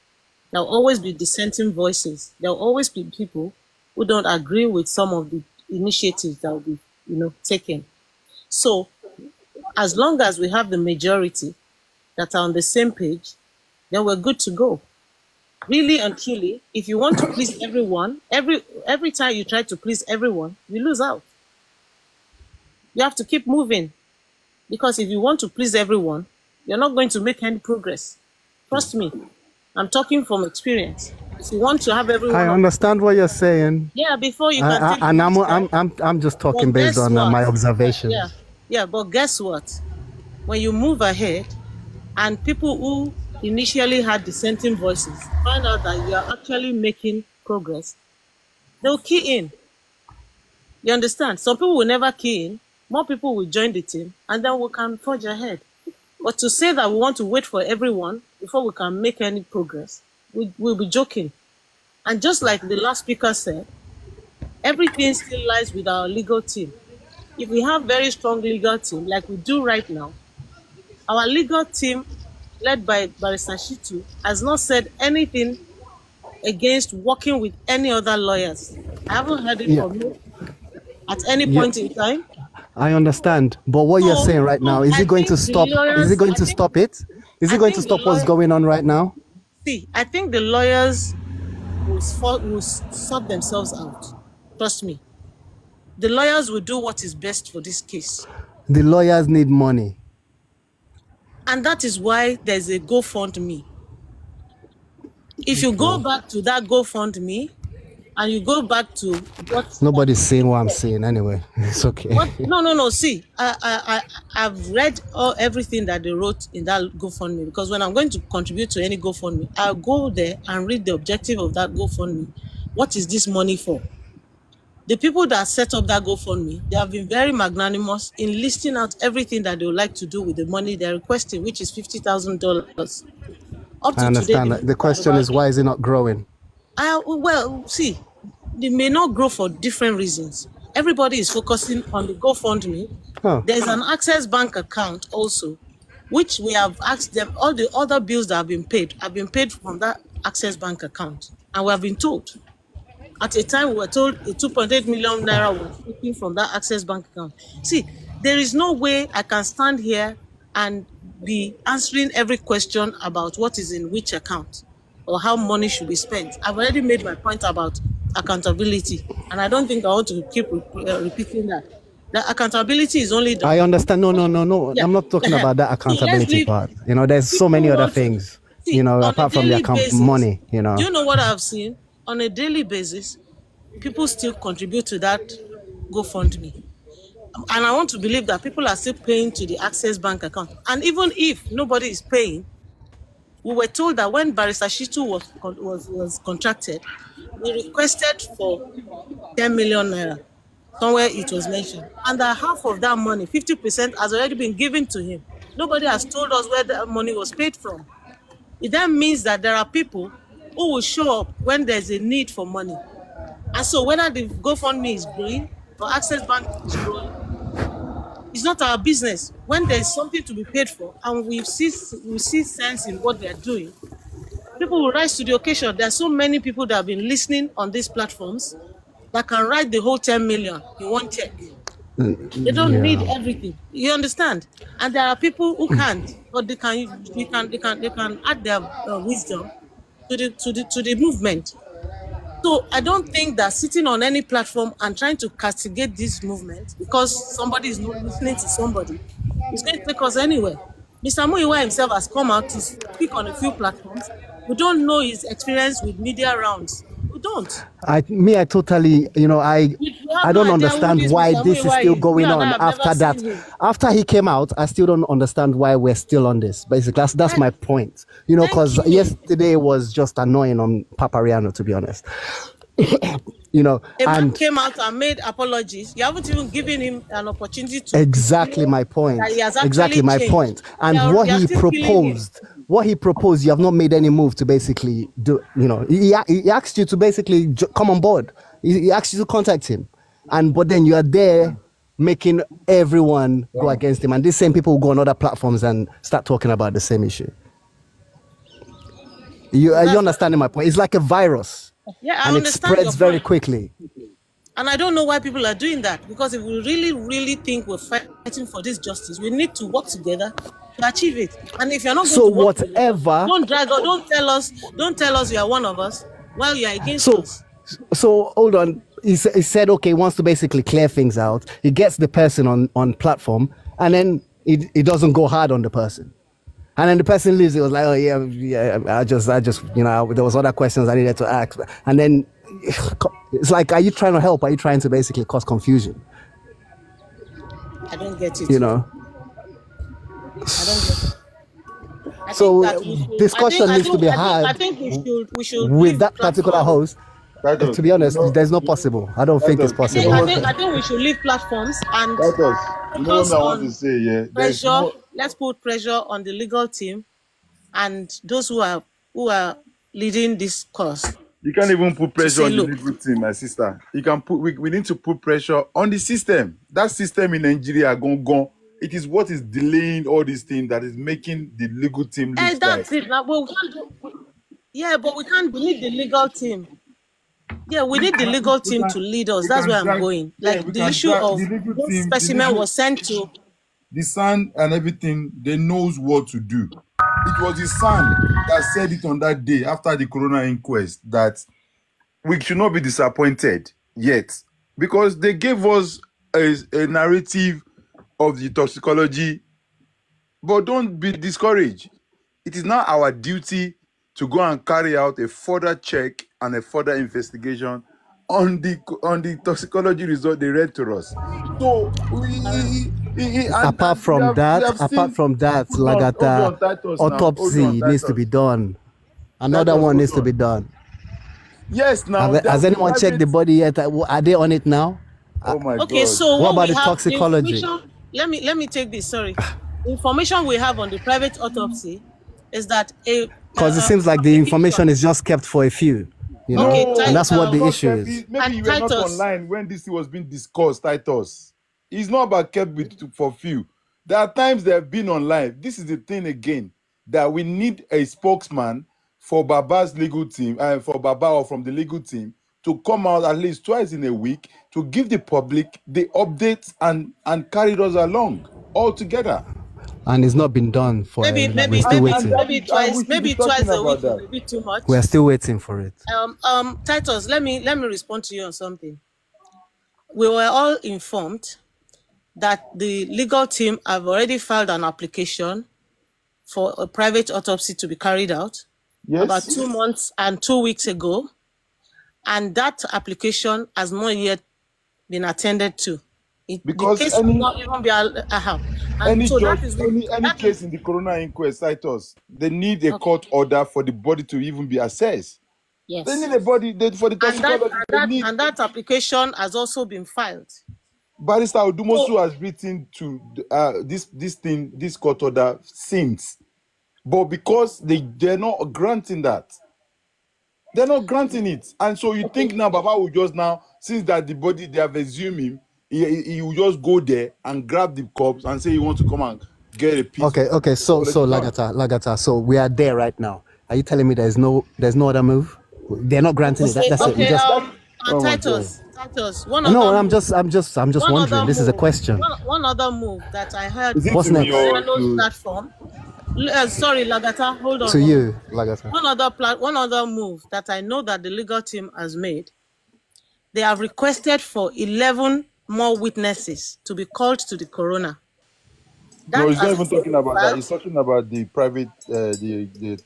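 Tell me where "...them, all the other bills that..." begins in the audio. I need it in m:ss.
2:27.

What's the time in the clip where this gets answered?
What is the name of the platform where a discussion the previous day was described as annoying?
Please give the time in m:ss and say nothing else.
4:30.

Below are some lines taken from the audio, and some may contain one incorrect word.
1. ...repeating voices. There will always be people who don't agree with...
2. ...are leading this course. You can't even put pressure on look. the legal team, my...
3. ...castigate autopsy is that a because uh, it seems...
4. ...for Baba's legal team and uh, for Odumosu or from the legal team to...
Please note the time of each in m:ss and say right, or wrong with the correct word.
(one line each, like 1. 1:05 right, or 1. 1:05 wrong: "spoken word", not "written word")
1. 0:01 wrong: "dissenting", not "repeating"
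2. 5:59 right
3. 7:10 wrong: "private", not "castigate"
4. 7:29 wrong: "Baba", not "Odumosu".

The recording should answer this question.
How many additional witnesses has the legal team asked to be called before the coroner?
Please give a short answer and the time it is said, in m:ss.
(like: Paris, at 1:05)
11, at 9:04.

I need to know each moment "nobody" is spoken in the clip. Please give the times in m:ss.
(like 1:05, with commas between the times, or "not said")
1:49, 3:11, 3:25.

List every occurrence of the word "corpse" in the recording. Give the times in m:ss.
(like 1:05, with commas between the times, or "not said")
8:38.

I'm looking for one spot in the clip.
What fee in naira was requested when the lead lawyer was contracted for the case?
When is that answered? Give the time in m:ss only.
3:19.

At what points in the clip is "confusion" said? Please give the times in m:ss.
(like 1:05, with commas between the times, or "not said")
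5:35.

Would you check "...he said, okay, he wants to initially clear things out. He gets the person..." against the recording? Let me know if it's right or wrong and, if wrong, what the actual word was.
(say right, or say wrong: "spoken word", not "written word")
wrong: "basically", not "initially".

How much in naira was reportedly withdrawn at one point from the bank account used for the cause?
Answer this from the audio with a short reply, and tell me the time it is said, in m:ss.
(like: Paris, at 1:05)
2.8 million naira, at 2:34.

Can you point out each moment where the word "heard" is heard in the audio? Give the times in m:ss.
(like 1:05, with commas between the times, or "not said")
1:19, 8:53.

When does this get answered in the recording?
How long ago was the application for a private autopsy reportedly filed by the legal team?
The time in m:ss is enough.
7:59.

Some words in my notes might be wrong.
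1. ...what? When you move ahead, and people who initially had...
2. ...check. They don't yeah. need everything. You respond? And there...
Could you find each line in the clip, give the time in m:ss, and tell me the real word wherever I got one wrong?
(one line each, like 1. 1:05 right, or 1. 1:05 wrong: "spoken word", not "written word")
1. 0:39 right
2. 3:51 wrong: "understand", not "respond".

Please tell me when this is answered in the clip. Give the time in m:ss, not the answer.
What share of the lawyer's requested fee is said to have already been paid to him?
3:23.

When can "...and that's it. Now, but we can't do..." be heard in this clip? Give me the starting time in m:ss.
6:12.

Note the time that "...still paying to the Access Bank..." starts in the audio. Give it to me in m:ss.
3:08.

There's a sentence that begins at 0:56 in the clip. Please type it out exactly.
But to say that we want to wait for everyone before we can make any progress, we, will be joking.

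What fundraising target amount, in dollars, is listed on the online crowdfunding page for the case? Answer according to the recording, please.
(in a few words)
$50,000.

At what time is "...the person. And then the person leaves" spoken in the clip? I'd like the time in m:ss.
5:25.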